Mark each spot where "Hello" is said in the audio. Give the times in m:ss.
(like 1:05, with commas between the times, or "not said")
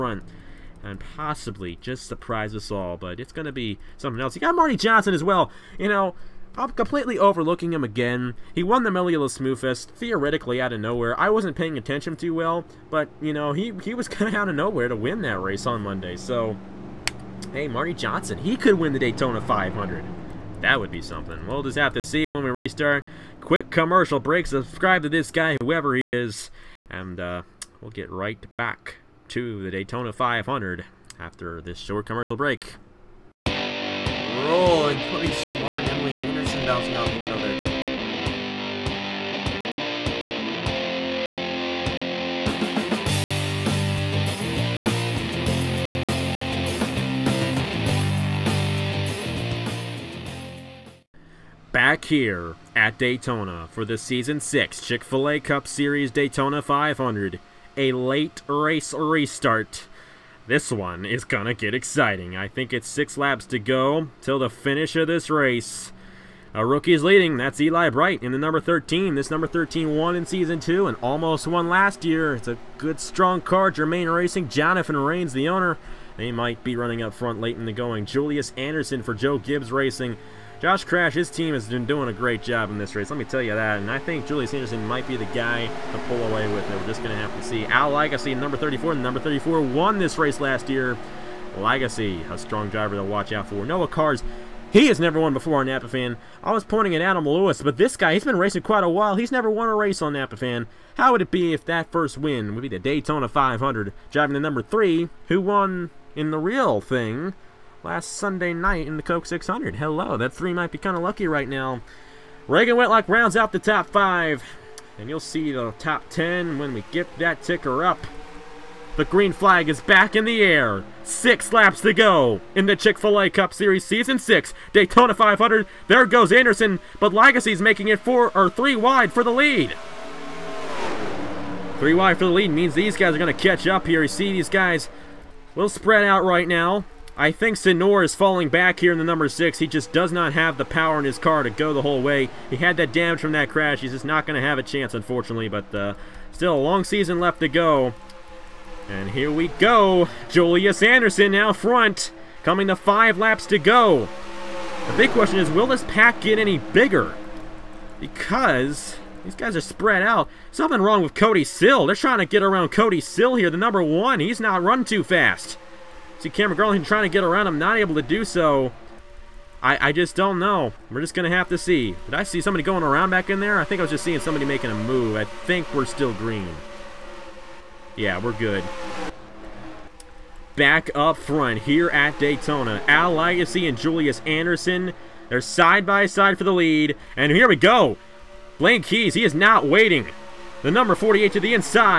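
1:49.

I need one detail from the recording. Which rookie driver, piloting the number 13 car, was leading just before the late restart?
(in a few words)
Eli Bright.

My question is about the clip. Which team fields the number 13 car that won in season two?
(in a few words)
Jermaine Racing.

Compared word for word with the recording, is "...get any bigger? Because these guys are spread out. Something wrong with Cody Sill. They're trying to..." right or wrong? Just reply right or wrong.
right.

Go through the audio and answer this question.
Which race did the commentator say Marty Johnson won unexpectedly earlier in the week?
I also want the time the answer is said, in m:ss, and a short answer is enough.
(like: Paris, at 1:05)
Mellow Yellow Smooth Fest, at 0:08.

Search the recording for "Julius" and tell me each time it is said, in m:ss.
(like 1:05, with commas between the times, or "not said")
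1:18, 1:24, 2:30, 3:03.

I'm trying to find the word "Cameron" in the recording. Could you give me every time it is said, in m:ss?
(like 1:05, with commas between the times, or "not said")
2:46.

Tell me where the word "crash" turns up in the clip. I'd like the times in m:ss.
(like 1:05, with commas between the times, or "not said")
1:20, 2:23.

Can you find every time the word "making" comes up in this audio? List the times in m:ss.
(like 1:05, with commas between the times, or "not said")
2:07, 2:54.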